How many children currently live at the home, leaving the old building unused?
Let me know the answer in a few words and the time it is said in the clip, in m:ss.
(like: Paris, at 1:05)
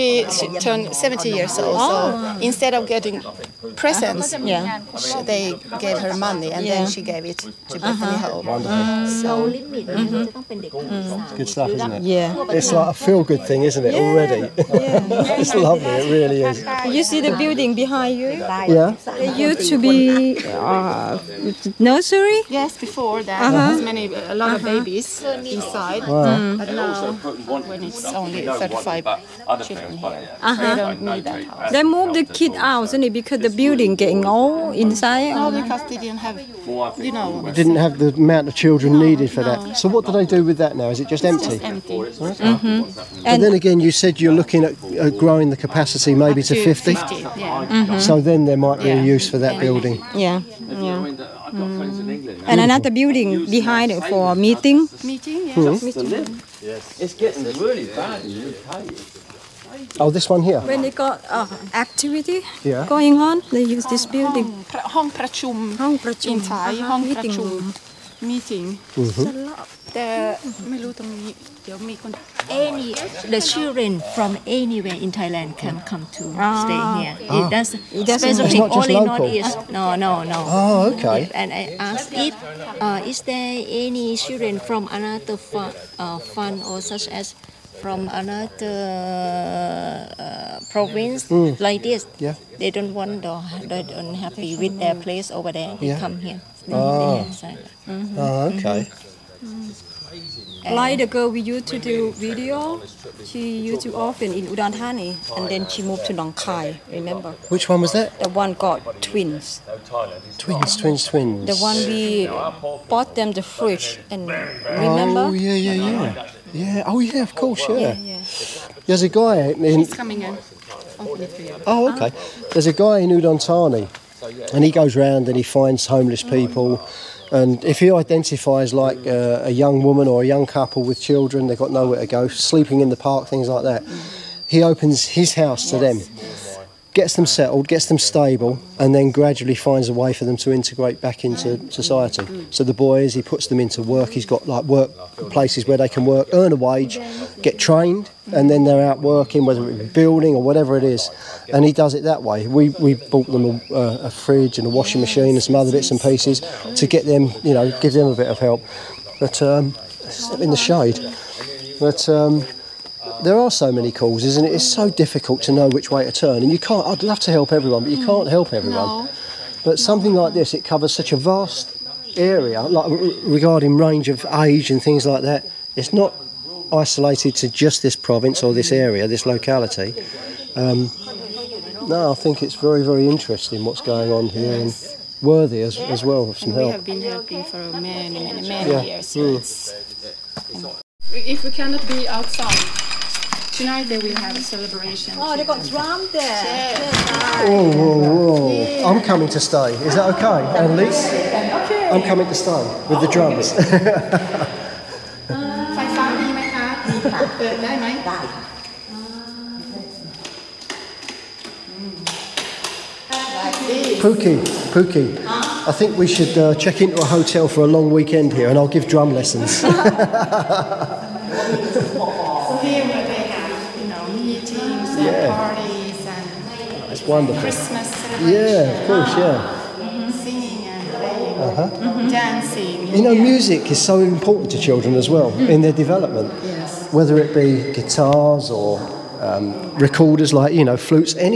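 35, at 0:28.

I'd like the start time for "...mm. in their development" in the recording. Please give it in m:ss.
3:55.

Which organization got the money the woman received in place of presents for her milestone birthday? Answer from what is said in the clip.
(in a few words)
Bethany Hope.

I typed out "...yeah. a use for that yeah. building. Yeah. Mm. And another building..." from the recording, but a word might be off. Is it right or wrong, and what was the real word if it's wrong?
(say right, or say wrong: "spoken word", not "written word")
right.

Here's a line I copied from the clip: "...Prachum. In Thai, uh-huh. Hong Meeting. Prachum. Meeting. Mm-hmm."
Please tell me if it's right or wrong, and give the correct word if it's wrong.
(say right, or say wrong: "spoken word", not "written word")
right.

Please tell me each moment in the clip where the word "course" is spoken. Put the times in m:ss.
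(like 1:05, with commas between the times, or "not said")
1:57, 3:48.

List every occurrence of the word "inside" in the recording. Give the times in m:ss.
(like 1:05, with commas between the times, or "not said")
0:25, 0:34.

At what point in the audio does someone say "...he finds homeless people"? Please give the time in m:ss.
2:05.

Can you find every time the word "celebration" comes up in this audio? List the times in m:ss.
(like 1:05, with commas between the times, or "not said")
3:14, 3:47.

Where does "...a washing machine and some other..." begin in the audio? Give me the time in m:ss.
2:34.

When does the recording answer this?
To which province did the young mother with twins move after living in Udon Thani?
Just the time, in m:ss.
1:46.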